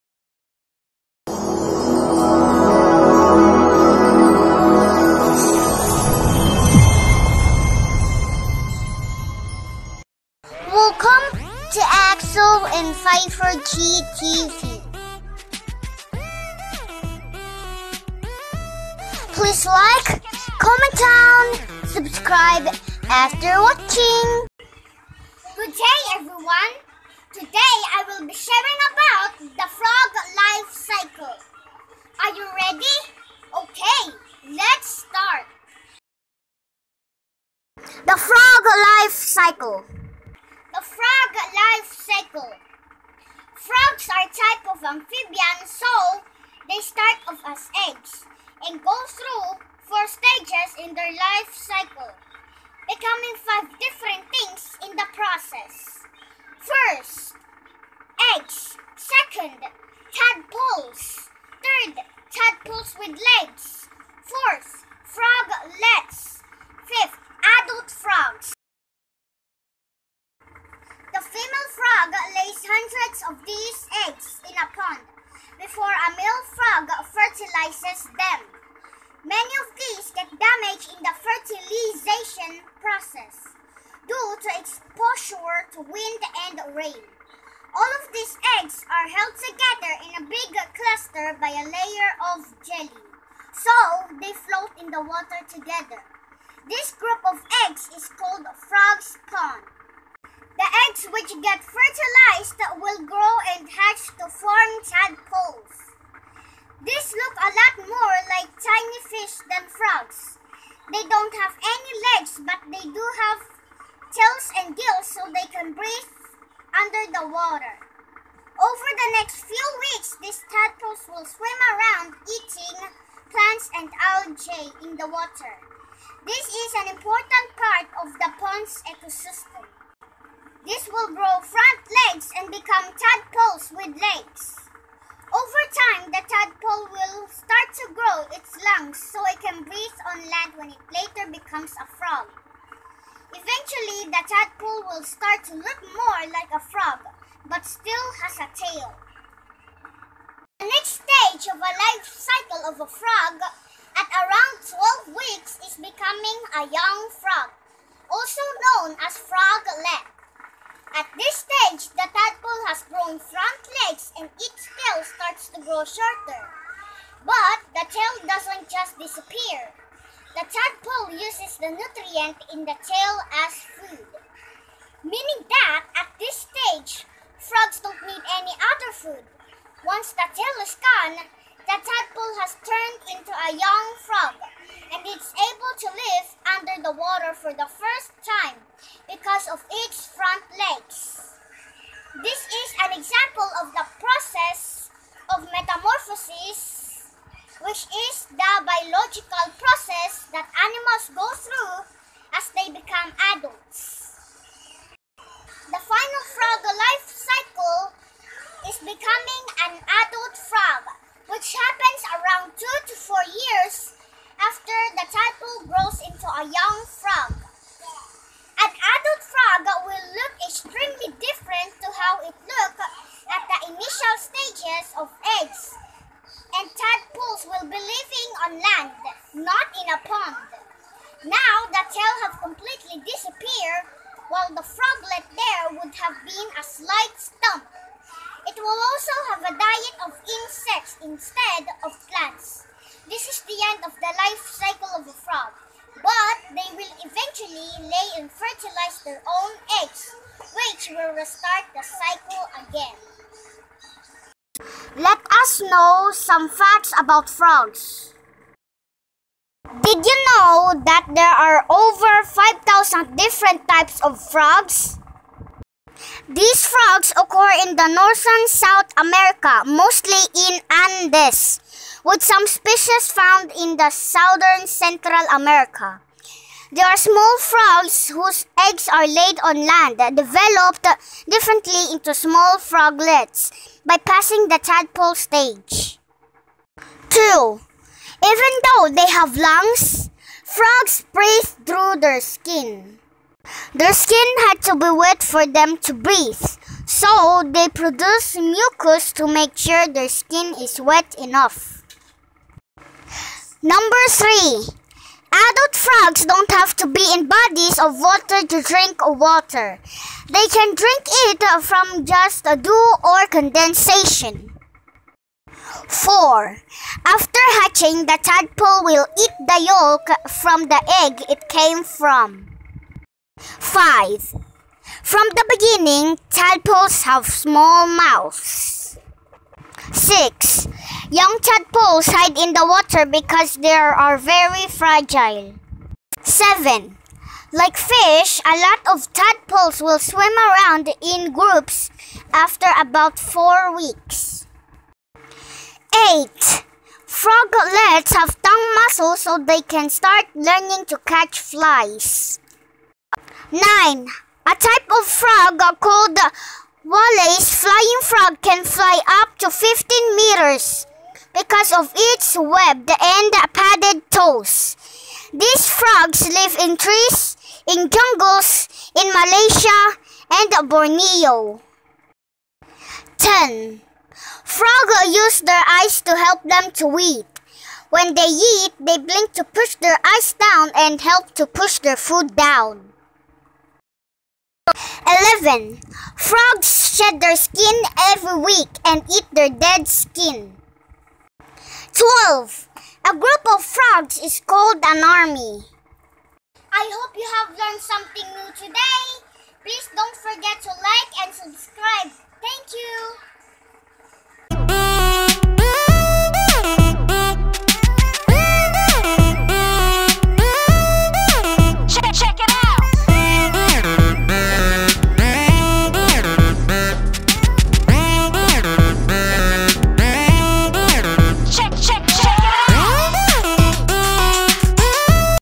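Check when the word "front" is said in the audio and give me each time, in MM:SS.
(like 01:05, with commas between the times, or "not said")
02:11, 02:43, 03:10.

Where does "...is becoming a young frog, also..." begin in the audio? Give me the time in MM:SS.
02:35.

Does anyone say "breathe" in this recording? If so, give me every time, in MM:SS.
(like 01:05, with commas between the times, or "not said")
01:55, 02:19, 04:51, 04:55.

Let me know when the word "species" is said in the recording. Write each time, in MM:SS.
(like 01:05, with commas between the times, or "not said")
04:32.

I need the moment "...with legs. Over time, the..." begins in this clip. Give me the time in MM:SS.
02:13.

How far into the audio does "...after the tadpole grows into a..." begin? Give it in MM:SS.
03:34.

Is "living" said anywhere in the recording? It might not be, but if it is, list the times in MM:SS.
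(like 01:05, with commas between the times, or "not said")
03:47.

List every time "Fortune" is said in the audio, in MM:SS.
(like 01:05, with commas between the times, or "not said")
not said.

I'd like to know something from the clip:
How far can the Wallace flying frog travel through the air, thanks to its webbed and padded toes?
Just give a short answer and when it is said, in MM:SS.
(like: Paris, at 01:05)
15 meters, at 05:59.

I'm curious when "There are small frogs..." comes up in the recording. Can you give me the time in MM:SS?
04:36.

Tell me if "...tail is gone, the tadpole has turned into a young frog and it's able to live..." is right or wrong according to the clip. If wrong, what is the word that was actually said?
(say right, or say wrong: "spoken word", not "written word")
right.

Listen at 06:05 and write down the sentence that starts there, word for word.
These frogs live in trees, in jungles, in Malaysia, and Borneo.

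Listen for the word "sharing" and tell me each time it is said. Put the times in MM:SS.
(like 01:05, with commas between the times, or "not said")
00:28.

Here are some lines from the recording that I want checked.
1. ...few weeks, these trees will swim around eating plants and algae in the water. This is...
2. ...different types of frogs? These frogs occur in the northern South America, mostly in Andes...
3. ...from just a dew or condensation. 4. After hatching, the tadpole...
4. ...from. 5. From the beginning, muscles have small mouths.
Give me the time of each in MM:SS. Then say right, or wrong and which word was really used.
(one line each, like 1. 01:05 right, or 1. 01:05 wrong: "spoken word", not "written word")
1. 01:59 wrong: "tadpoles", not "trees"
2. 04:23 right
3. 05:11 right
4. 05:21 wrong: "tadpoles", not "muscles".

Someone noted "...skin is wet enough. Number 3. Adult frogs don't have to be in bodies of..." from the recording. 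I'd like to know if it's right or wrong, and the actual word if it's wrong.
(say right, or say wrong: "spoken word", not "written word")
right.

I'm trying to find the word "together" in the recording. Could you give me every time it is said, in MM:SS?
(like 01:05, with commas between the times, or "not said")
01:29, 01:35.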